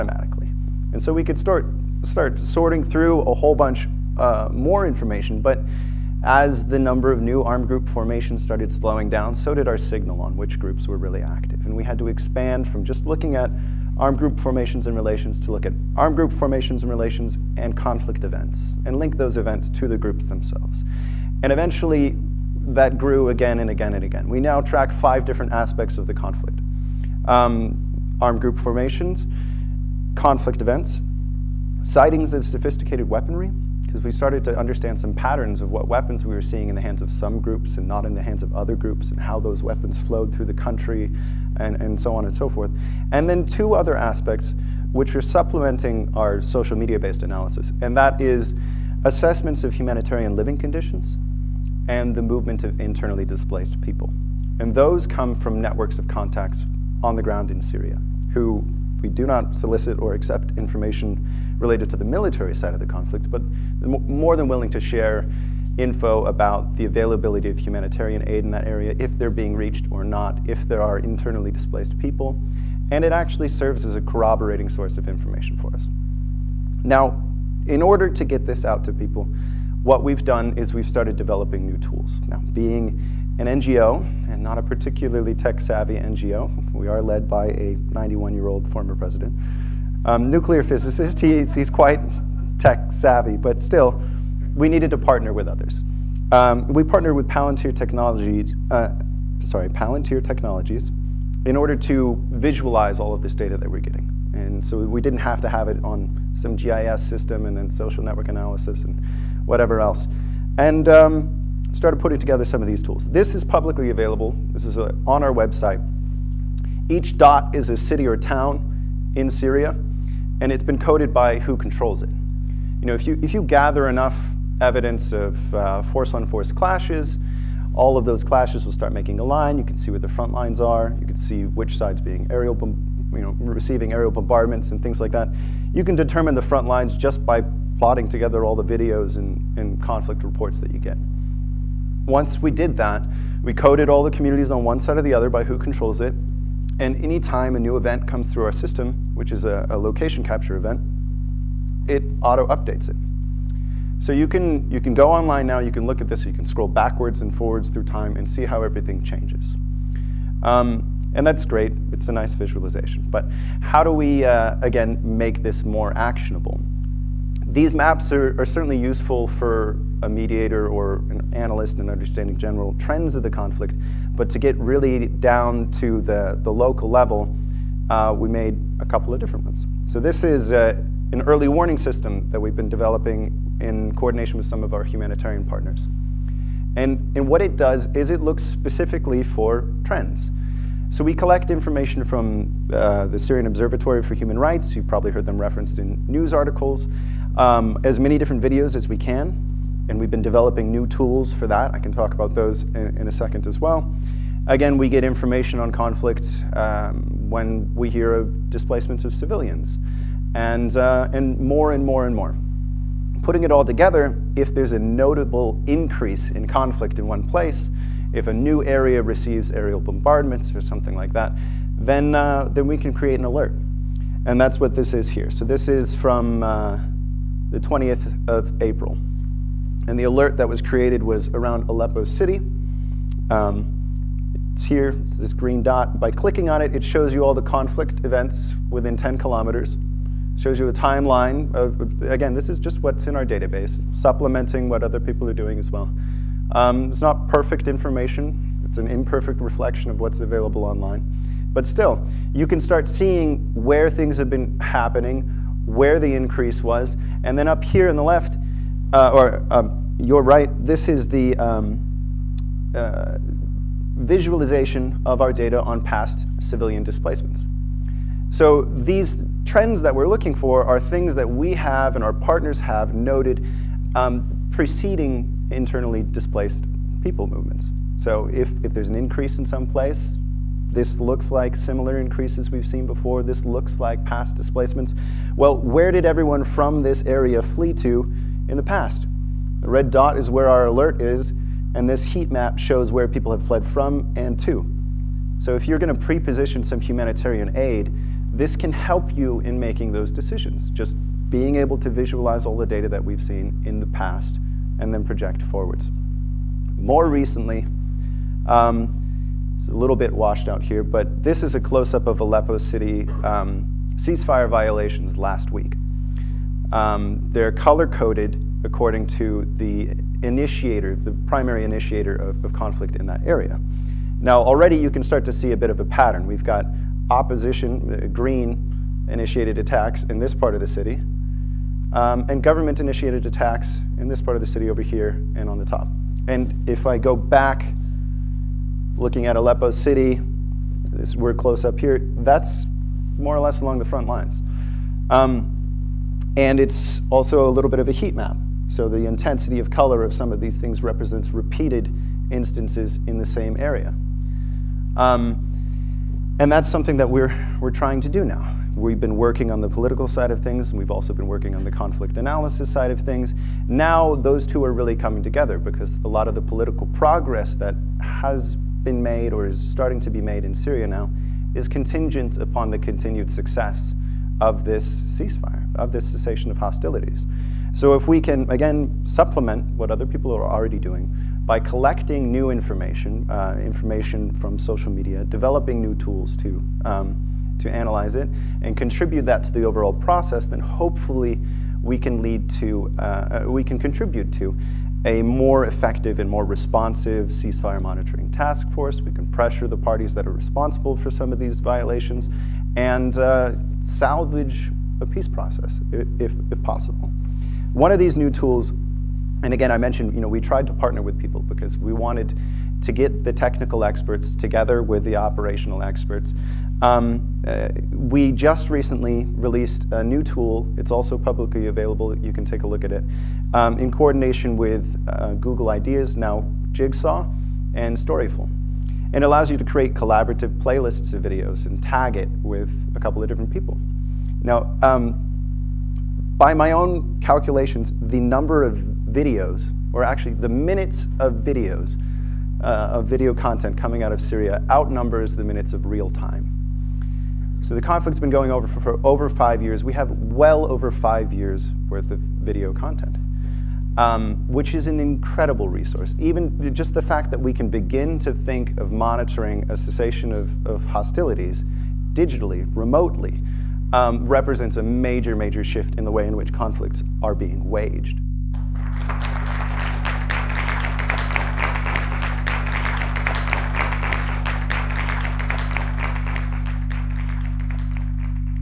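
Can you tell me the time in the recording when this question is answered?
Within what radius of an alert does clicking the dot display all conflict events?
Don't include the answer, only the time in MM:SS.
03:58.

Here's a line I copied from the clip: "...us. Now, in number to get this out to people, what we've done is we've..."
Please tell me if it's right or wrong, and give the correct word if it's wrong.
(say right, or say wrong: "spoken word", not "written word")
wrong: "order", not "number".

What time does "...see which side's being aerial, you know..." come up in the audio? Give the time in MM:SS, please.
02:11.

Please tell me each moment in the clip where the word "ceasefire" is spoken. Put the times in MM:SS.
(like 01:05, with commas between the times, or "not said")
05:13, 06:15, 06:37.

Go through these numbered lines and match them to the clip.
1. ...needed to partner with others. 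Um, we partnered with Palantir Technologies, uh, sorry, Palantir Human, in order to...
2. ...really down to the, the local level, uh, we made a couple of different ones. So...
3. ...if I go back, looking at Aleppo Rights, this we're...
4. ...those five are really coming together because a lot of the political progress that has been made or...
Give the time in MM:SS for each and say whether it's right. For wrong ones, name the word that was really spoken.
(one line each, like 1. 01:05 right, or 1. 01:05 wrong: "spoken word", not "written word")
1. 01:34 wrong: "Technologies", not "Human"
2. 02:54 right
3. 05:36 wrong: "City", not "Rights"
4. 06:04 wrong: "two", not "five".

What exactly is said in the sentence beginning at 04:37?
So if, if there's an increase in some place, this looks like similar increases we've seen before.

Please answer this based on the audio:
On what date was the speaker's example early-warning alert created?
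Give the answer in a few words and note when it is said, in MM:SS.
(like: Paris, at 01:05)
20 April, at 03:47.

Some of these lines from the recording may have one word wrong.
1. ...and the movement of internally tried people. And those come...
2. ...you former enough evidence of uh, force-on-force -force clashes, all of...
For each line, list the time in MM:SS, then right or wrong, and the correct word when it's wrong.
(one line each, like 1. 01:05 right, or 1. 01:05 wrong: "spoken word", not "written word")
1. 00:51 wrong: "displaced", not "tried"
2. 02:03 wrong: "gather", not "former".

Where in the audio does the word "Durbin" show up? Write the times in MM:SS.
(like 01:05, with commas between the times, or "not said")
not said.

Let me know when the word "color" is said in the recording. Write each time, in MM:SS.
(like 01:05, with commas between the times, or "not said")
05:17, 05:49.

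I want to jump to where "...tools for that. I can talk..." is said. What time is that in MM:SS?
03:20.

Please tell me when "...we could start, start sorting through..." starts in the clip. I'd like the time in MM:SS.
00:01.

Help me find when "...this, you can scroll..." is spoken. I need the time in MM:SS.
02:36.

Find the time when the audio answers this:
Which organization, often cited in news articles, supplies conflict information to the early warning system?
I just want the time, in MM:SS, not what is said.
03:13.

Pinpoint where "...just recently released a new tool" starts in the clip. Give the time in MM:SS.
06:58.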